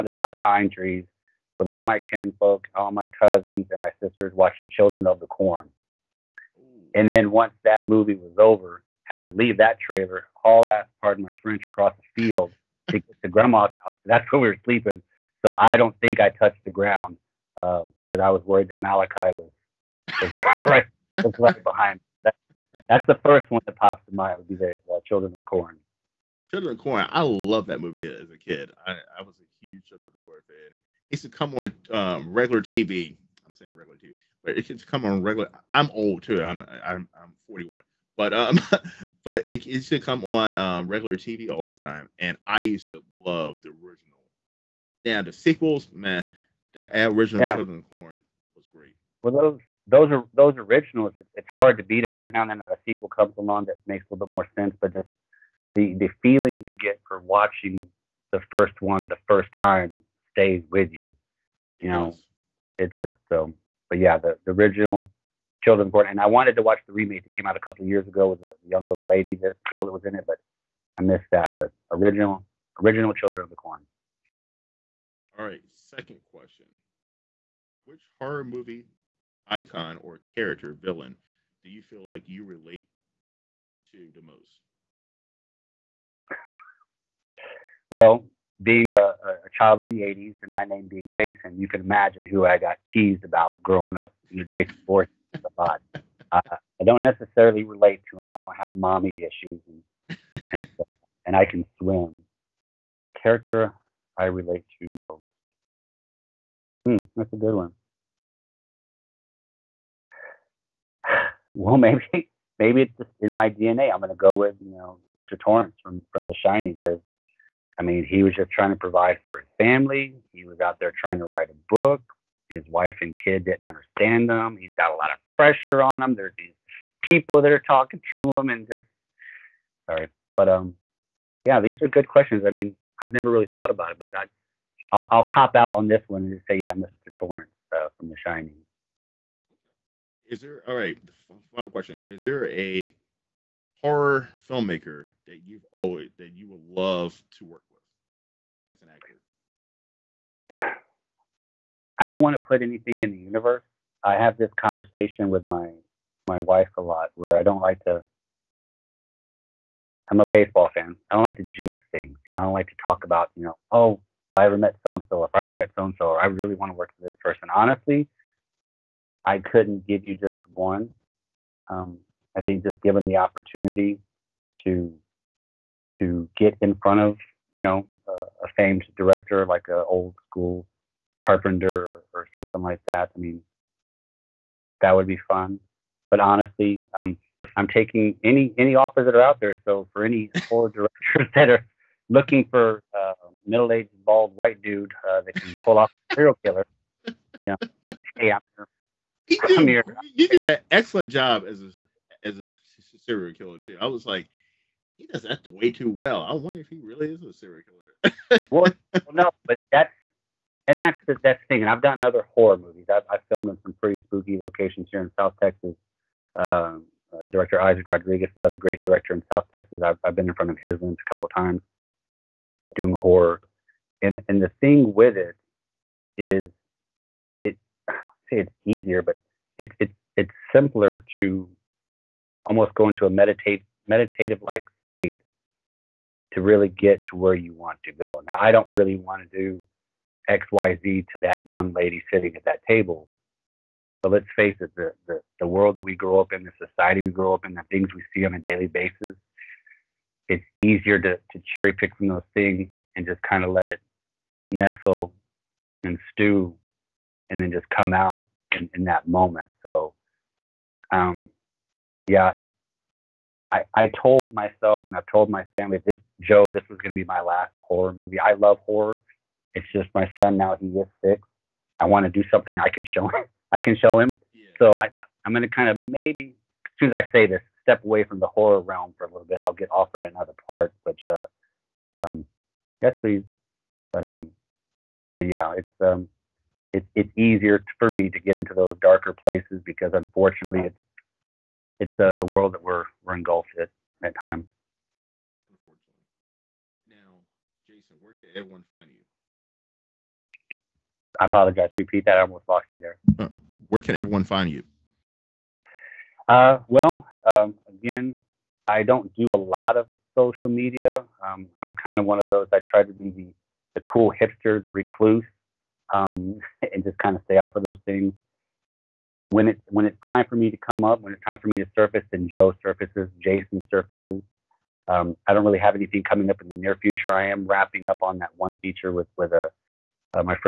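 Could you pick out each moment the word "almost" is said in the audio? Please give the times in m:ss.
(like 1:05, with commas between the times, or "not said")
3:52, 5:02.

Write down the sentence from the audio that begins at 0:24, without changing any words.
Would be the uh, Children of the Corn.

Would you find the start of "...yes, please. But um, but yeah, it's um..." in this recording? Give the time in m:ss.
4:42.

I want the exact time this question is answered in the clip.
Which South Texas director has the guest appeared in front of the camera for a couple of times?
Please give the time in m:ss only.
3:37.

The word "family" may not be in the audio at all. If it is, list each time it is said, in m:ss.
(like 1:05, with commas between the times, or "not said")
1:59, 4:25.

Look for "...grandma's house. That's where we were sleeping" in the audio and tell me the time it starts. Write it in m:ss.
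0:13.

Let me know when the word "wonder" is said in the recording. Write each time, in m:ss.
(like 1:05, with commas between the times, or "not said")
3:26.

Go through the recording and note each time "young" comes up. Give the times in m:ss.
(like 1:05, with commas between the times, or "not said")
1:08, 4:01.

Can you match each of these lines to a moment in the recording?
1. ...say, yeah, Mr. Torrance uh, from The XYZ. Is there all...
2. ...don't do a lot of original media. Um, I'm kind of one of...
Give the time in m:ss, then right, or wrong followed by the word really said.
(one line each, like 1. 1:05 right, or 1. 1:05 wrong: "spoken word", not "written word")
1. 2:16 wrong: "Shining", not "XYZ"
2. 5:08 wrong: "social", not "original".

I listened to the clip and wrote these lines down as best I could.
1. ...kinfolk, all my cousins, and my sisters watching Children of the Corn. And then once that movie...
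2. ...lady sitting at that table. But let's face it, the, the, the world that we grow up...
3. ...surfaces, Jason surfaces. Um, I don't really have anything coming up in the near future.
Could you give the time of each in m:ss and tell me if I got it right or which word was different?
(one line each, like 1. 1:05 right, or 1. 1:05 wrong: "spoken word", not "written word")
1. 0:02 right
2. 4:01 right
3. 5:22 right.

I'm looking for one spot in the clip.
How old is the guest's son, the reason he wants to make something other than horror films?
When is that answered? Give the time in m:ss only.
4:31.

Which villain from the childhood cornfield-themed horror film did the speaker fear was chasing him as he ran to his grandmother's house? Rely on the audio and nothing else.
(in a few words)
Malachi.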